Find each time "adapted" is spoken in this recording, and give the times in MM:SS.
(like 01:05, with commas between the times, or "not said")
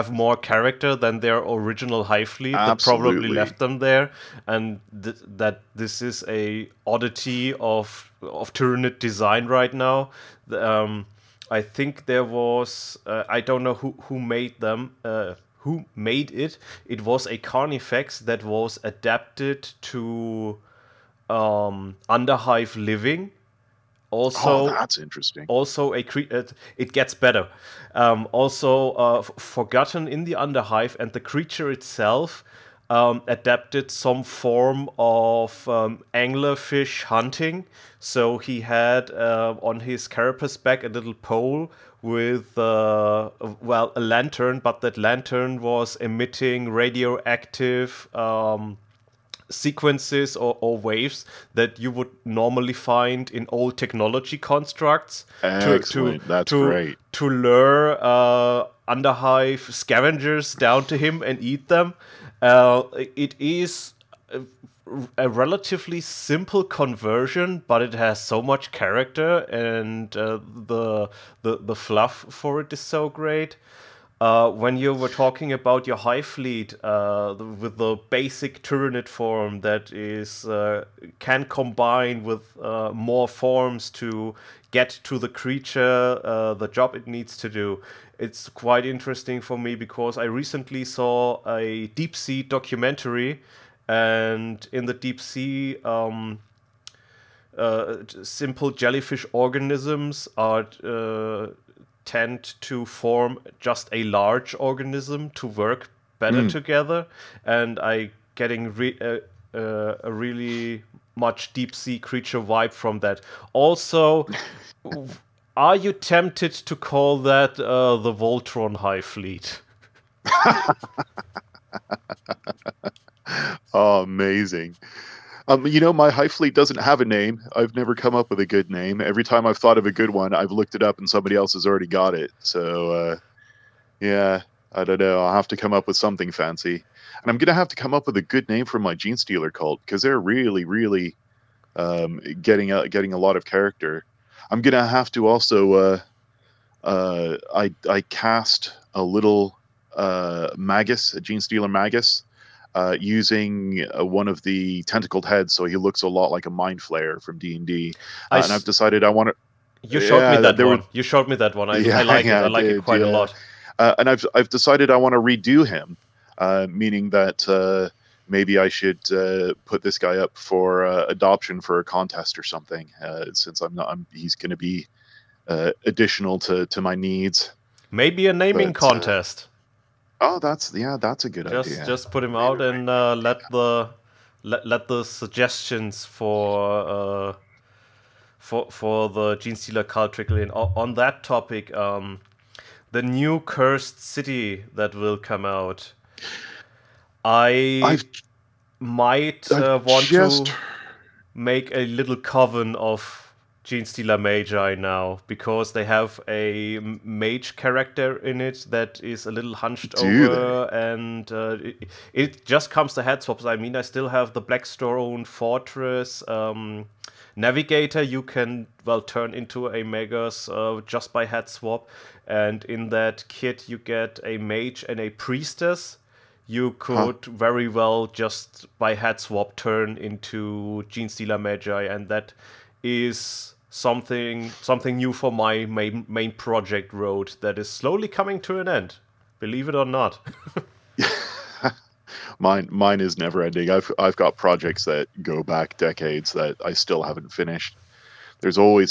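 00:18, 00:33.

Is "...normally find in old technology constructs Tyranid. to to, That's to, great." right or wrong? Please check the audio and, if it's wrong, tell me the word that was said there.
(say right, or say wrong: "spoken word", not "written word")
wrong: "Excellent", not "Tyranid".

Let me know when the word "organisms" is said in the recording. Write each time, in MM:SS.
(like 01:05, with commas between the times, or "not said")
01:39, 01:44.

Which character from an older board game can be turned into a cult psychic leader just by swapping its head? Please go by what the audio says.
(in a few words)
Navigator.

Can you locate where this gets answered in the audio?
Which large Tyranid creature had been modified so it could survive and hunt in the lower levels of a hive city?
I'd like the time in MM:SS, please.
00:17.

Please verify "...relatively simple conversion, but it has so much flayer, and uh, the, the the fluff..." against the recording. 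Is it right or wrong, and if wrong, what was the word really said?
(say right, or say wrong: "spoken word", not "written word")
wrong: "character", not "flayer".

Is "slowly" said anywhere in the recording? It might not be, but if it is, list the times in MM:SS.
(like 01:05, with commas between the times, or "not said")
03:57.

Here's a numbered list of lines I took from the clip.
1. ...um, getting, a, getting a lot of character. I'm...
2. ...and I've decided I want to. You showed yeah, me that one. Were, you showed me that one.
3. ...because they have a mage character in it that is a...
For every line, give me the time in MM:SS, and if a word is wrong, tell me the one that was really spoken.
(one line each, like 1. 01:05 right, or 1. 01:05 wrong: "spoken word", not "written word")
1. 02:21 right
2. 02:38 right
3. 03:25 right.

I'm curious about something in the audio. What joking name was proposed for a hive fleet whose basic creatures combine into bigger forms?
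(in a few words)
Voltron Hive Fleet.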